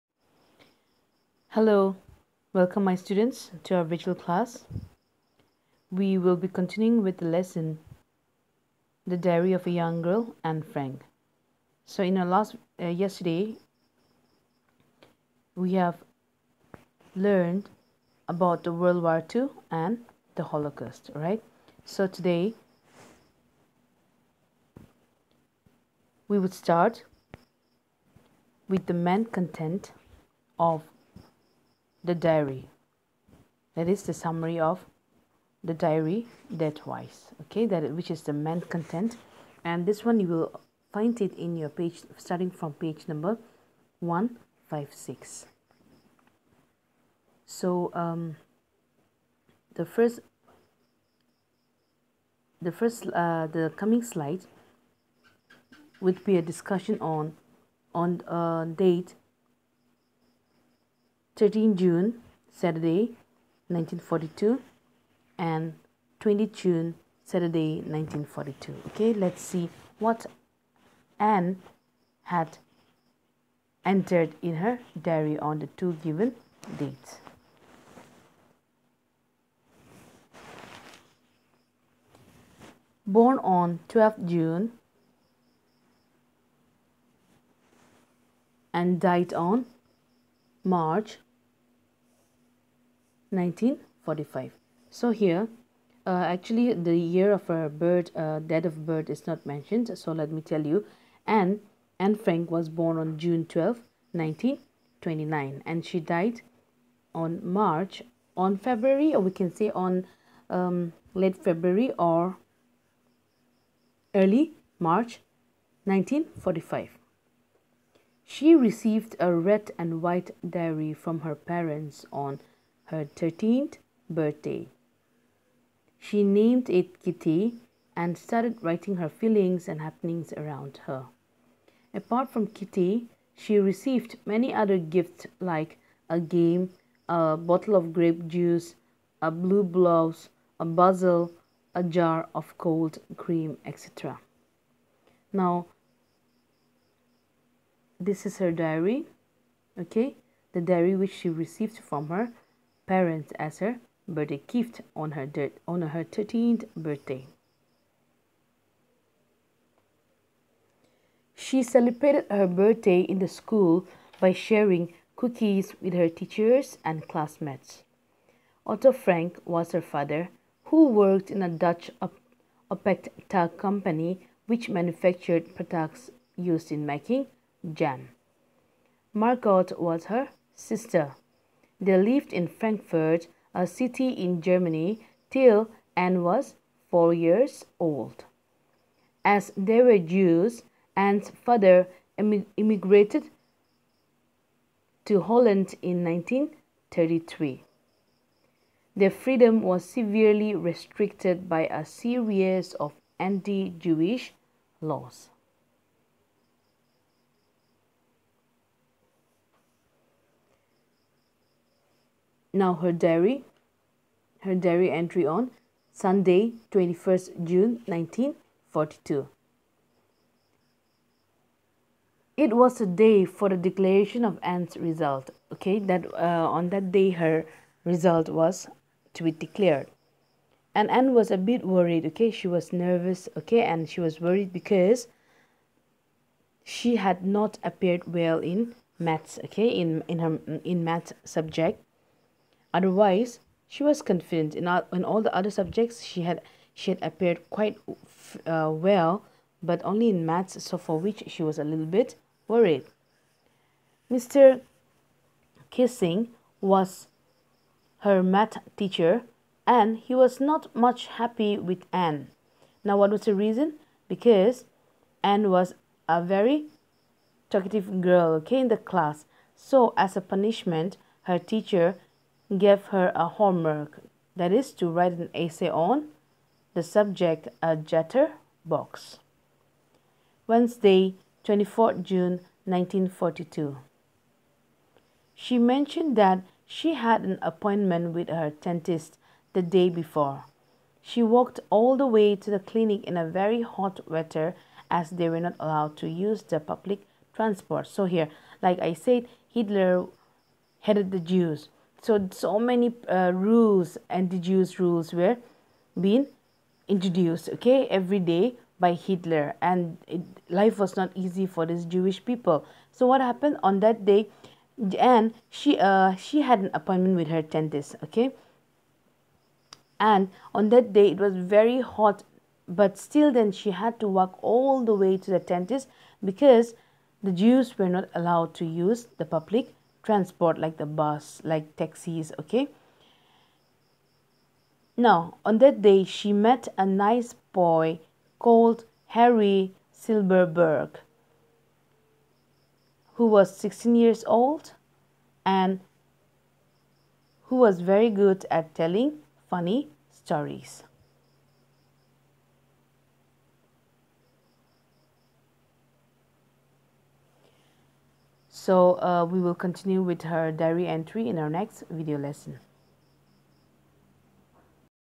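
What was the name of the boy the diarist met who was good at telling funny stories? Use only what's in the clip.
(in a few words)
Harry Silverberg.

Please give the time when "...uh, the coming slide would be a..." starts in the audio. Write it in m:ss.
0:53.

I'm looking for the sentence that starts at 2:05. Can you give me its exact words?
She named it Kitty and started writing her feelings and happenings around her.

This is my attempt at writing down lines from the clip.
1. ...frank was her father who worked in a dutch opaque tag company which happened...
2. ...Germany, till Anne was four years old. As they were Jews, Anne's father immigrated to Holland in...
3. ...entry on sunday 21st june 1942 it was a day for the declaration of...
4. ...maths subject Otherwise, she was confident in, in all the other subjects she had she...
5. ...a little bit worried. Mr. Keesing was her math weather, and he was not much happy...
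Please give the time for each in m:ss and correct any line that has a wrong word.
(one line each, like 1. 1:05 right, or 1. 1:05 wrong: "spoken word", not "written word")
1. 2:48 wrong: "manufactured", not "happened"
2. 3:04 right
3. 3:34 right
4. 4:00 right
5. 4:11 wrong: "teacher", not "weather".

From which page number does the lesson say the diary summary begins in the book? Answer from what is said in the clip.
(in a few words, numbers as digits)
156.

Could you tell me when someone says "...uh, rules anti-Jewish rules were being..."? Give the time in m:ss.
5:03.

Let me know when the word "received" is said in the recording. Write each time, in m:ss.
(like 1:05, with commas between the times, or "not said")
1:58, 2:13, 2:31.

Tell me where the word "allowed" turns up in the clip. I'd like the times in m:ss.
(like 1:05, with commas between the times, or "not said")
4:55, 5:28.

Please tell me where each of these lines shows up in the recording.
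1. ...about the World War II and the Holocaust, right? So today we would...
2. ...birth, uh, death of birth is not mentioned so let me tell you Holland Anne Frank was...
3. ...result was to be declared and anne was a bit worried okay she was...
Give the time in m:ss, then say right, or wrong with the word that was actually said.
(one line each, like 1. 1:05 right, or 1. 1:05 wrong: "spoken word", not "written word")
1. 0:18 right
2. 1:37 wrong: "Anne", not "Holland"
3. 3:47 right.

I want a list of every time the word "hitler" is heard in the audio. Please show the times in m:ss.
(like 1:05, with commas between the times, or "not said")
4:59, 5:08.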